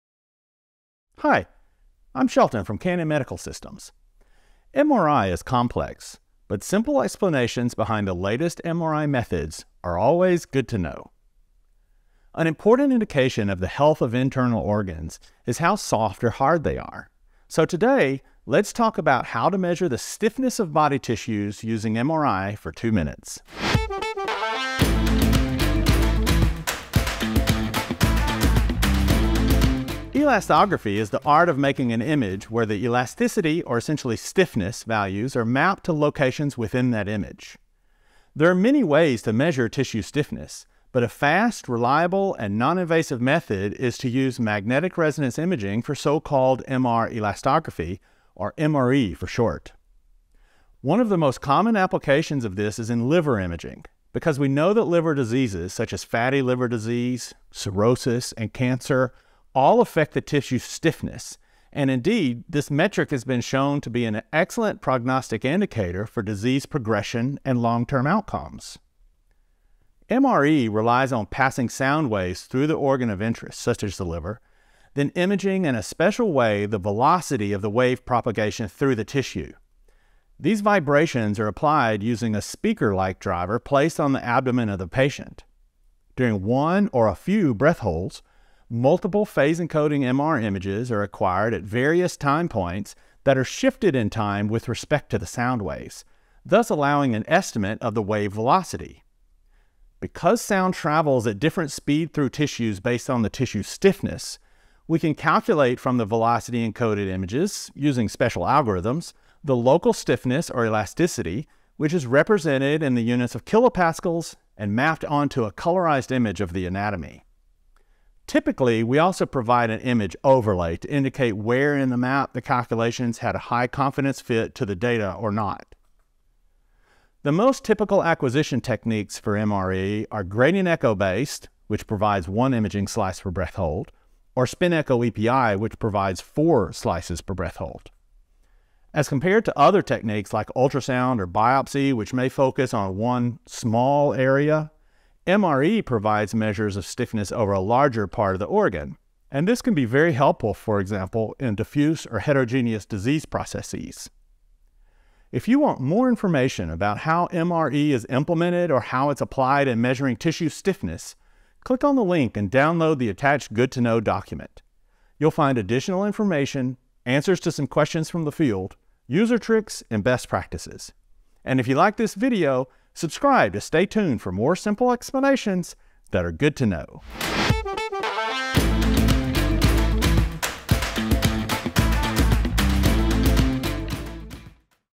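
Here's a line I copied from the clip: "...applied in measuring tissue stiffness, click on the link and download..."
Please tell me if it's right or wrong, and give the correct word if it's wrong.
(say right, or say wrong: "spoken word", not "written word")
right.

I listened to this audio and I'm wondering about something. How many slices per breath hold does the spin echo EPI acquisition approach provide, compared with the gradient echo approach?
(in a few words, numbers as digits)
4.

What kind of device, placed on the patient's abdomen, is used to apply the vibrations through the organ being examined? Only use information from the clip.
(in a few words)
speaker like driver.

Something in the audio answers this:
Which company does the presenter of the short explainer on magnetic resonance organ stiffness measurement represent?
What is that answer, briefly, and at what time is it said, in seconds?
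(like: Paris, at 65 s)
Canon Medical Systems, at 2 s.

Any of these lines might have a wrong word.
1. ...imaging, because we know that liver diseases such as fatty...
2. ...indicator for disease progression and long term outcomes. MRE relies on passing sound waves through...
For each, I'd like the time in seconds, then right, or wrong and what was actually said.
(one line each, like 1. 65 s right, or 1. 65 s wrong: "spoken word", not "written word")
1. 53 s right
2. 65 s right.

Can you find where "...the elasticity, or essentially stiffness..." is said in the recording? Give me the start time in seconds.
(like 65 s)
32 s.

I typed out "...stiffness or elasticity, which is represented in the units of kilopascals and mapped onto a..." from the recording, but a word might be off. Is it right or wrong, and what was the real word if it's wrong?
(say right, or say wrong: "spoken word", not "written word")
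right.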